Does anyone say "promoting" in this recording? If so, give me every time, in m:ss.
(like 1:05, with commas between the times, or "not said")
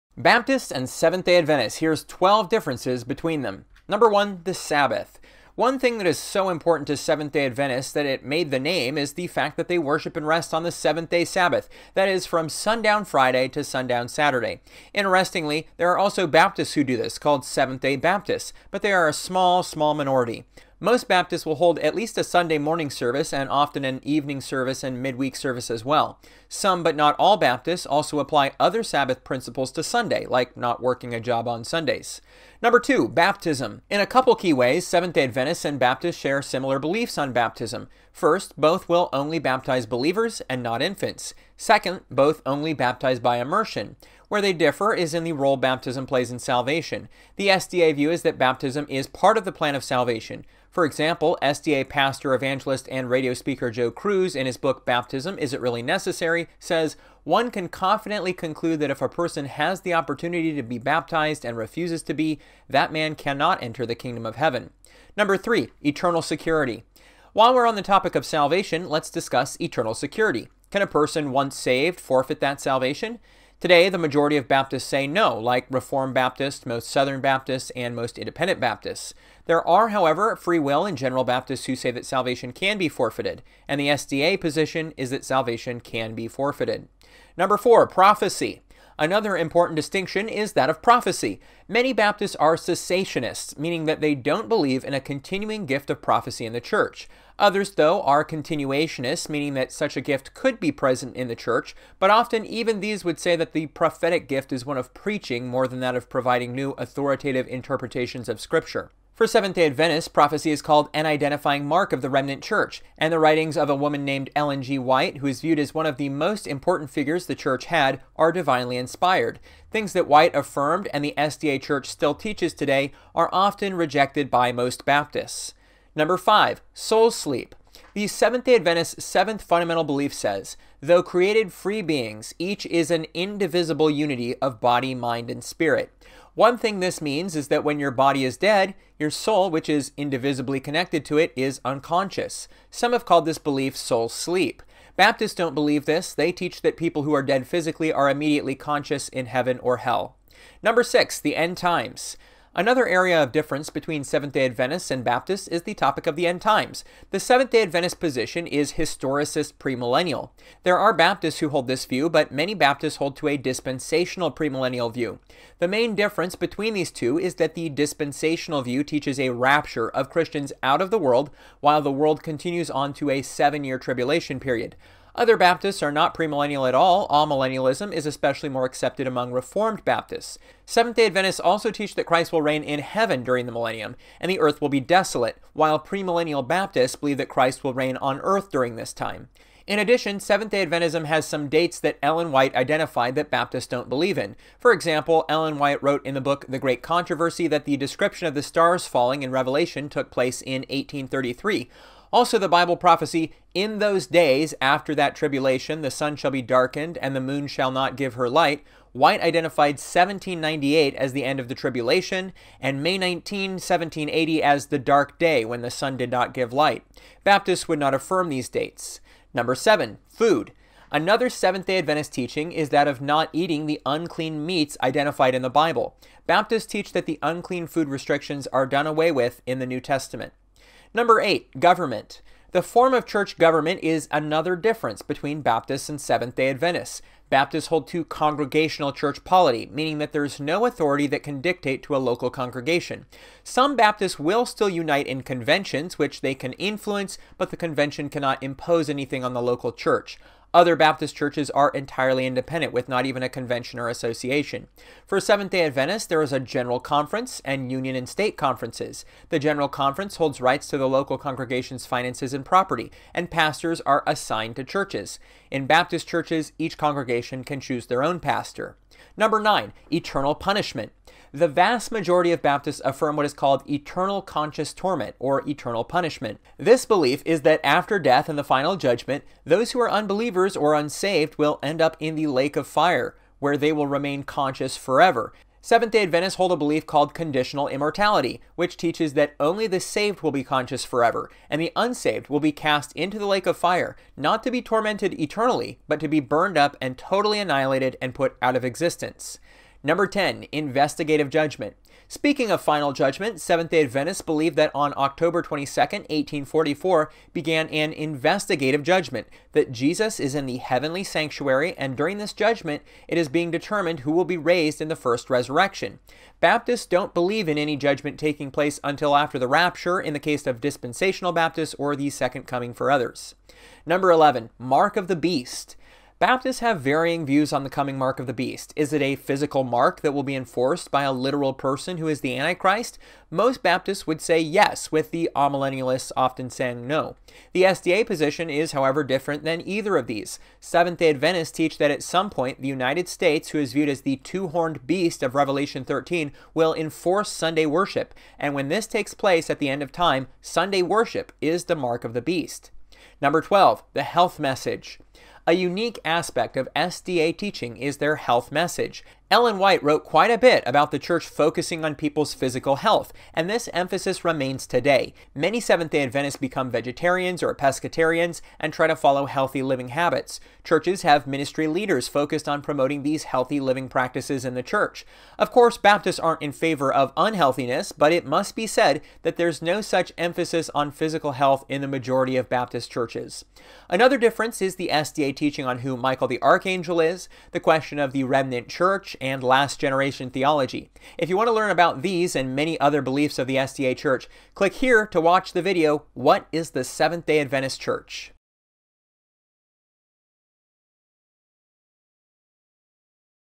6:12.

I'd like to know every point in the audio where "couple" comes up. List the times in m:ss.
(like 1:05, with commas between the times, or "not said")
0:34.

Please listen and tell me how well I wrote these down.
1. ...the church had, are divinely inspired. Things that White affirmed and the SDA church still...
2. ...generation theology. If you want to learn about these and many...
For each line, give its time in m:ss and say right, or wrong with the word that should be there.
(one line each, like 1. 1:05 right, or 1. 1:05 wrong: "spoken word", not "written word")
1. 1:57 right
2. 6:29 right.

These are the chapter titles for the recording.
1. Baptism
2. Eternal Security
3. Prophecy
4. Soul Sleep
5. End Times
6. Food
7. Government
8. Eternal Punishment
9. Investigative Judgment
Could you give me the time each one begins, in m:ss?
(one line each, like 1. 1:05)
1. 0:31
2. 1:04
3. 1:27
4. 2:05
5. 2:30
6. 3:39
7. 3:50
8. 4:29
9. 4:59.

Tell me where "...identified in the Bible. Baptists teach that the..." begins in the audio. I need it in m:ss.
3:44.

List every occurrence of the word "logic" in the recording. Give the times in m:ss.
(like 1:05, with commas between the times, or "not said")
not said.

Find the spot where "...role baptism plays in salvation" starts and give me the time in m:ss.
0:45.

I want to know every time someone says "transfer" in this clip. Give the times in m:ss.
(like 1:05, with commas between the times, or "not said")
not said.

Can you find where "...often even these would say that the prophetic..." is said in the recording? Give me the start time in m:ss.
1:42.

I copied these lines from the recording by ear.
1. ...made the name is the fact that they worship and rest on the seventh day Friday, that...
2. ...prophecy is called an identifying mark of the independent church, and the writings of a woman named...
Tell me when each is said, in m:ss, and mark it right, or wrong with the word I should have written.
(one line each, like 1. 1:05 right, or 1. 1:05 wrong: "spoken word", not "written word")
1. 0:08 wrong: "Sabbath", not "Friday"
2. 1:50 wrong: "remnant", not "independent".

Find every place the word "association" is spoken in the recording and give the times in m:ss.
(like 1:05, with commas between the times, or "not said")
4:13.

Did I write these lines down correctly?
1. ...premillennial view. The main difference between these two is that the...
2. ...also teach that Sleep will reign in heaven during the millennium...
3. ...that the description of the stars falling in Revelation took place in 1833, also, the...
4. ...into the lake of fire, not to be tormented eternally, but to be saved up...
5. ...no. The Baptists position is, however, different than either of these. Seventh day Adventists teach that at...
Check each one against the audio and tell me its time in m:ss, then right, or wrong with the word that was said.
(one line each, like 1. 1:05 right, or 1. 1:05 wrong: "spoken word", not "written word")
1. 2:44 right
2. 3:01 wrong: "Christ", not "Sleep"
3. 3:17 right
4. 4:52 wrong: "burned", not "saved"
5. 5:36 wrong: "SDA", not "Baptists".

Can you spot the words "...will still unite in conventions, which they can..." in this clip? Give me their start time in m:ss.
4:04.